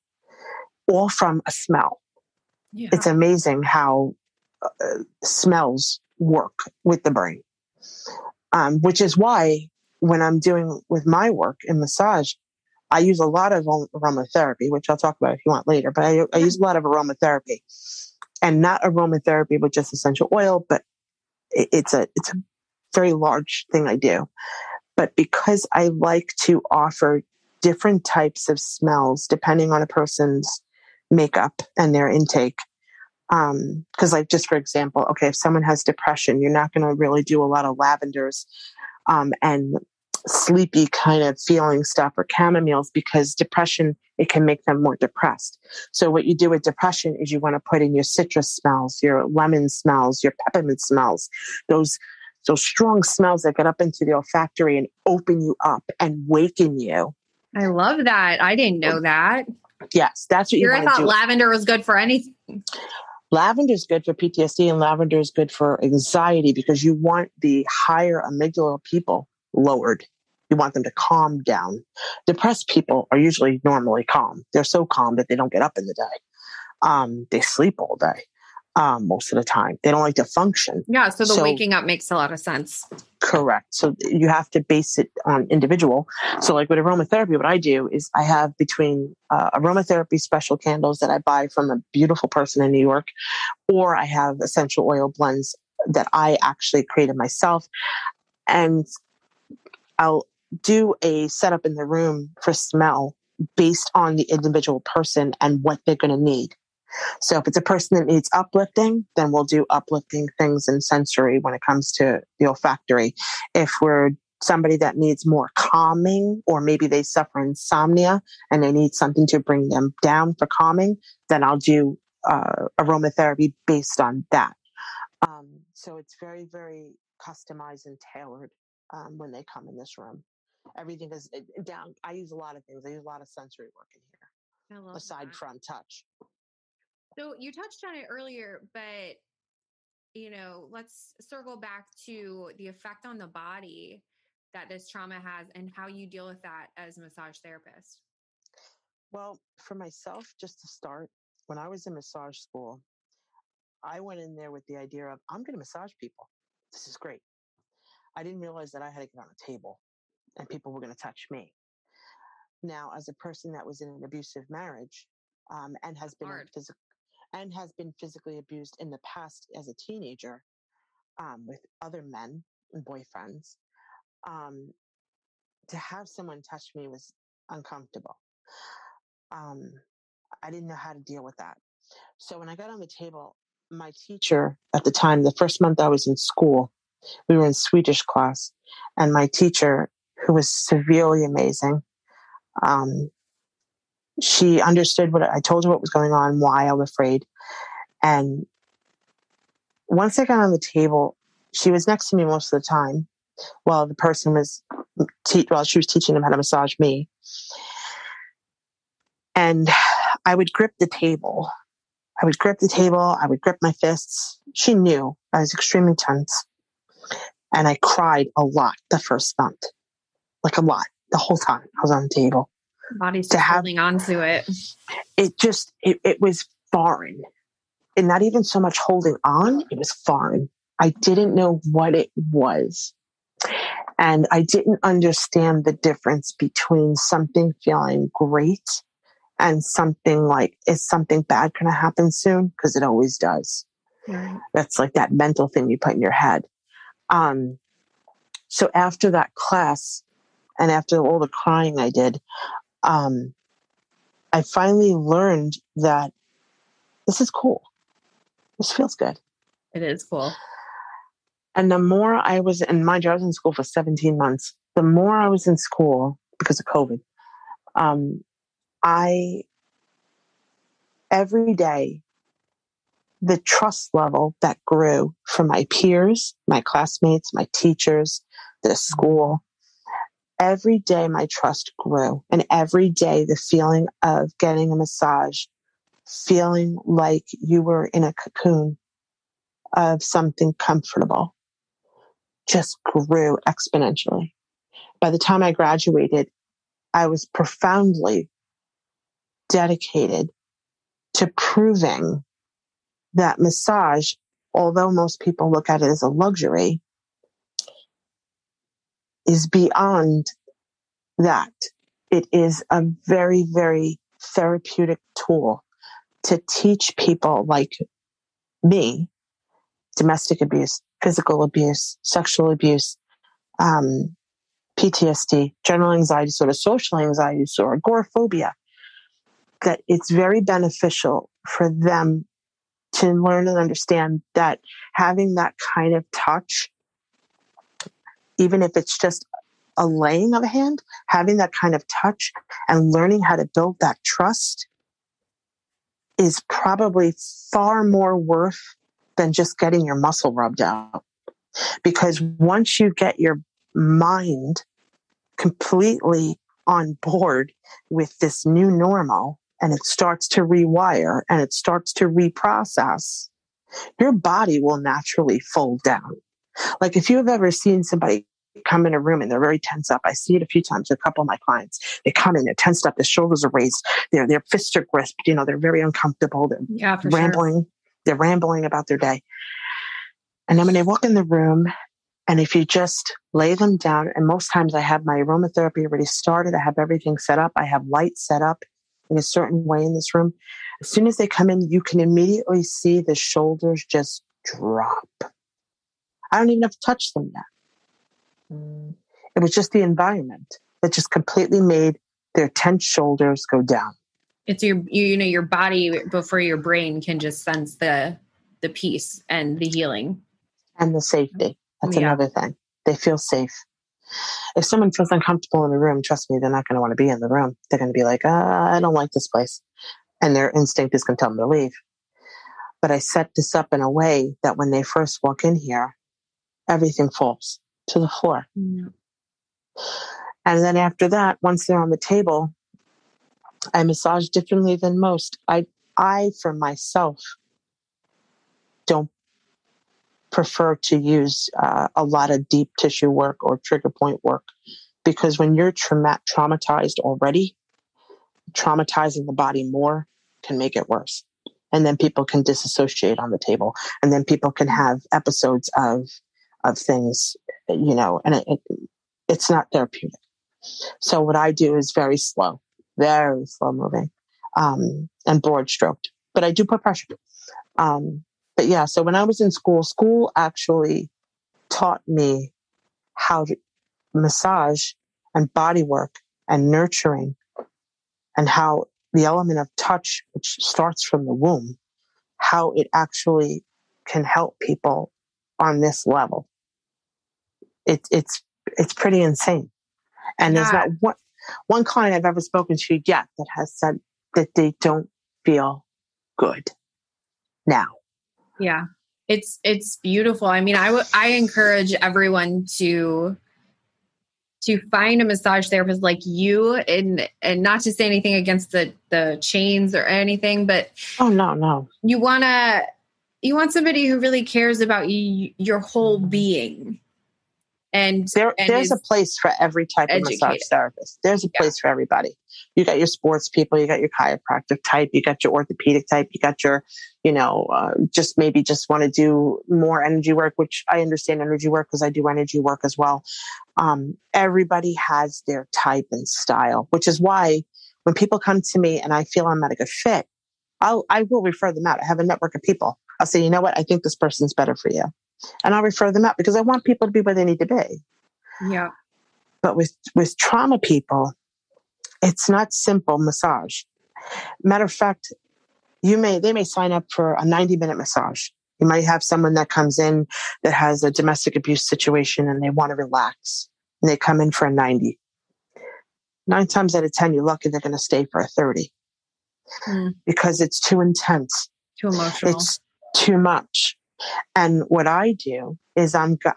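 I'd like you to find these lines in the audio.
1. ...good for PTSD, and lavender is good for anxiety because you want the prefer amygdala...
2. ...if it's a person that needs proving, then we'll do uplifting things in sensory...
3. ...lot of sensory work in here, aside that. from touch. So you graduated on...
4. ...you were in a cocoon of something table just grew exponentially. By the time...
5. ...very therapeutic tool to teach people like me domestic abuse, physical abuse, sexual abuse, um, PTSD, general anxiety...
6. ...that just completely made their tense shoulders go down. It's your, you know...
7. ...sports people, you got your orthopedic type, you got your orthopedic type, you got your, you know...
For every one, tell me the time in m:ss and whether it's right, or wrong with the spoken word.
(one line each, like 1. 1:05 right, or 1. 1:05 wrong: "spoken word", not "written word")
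1. 1:03 wrong: "higher", not "prefer"
2. 1:47 wrong: "uplifting", not "proving"
3. 2:13 wrong: "touched", not "graduated"
4. 4:47 wrong: "comfortable", not "table"
5. 5:13 right
6. 6:40 right
7. 8:43 wrong: "chiropractic", not "orthopedic".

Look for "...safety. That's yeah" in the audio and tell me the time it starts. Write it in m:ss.
6:51.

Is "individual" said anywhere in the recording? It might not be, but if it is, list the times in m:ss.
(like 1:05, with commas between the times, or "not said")
1:25, 1:44.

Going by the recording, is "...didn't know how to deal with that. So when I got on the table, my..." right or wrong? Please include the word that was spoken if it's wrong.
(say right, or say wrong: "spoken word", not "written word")
right.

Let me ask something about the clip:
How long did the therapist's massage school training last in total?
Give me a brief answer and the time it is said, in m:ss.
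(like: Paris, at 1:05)
17 months, at 4:23.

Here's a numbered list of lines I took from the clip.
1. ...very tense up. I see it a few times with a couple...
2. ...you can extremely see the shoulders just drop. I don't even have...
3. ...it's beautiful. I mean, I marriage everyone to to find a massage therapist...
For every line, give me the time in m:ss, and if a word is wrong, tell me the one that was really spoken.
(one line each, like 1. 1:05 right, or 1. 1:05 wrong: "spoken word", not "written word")
1. 6:09 right
2. 6:31 wrong: "immediately", not "extremely"
3. 8:19 wrong: "encourage", not "marriage".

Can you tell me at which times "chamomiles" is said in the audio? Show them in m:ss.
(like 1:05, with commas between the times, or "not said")
0:42.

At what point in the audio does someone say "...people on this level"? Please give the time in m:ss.
8:04.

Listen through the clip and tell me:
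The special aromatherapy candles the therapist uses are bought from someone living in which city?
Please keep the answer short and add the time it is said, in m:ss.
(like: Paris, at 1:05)
New York, at 1:32.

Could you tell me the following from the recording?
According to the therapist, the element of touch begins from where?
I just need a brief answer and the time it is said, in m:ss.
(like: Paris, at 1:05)
the womb, at 8:01.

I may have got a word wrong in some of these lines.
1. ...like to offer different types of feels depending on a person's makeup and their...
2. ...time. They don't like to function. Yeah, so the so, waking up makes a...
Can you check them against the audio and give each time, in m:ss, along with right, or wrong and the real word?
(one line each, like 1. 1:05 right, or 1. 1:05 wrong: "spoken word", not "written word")
1. 0:25 wrong: "smells", not "feels"
2. 1:19 right.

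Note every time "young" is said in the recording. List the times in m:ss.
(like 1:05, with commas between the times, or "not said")
not said.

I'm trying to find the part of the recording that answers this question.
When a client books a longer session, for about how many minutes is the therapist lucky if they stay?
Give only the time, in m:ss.
9:28.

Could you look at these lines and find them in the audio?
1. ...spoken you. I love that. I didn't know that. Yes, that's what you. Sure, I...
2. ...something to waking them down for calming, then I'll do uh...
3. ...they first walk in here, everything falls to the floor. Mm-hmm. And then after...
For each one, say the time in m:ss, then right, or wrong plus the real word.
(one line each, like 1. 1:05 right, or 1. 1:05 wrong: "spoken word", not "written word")
1. 0:56 wrong: "waken", not "spoken"
2. 1:58 wrong: "bring", not "waking"
3. 7:04 right.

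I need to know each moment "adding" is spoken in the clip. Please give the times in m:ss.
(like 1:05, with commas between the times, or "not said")
not said.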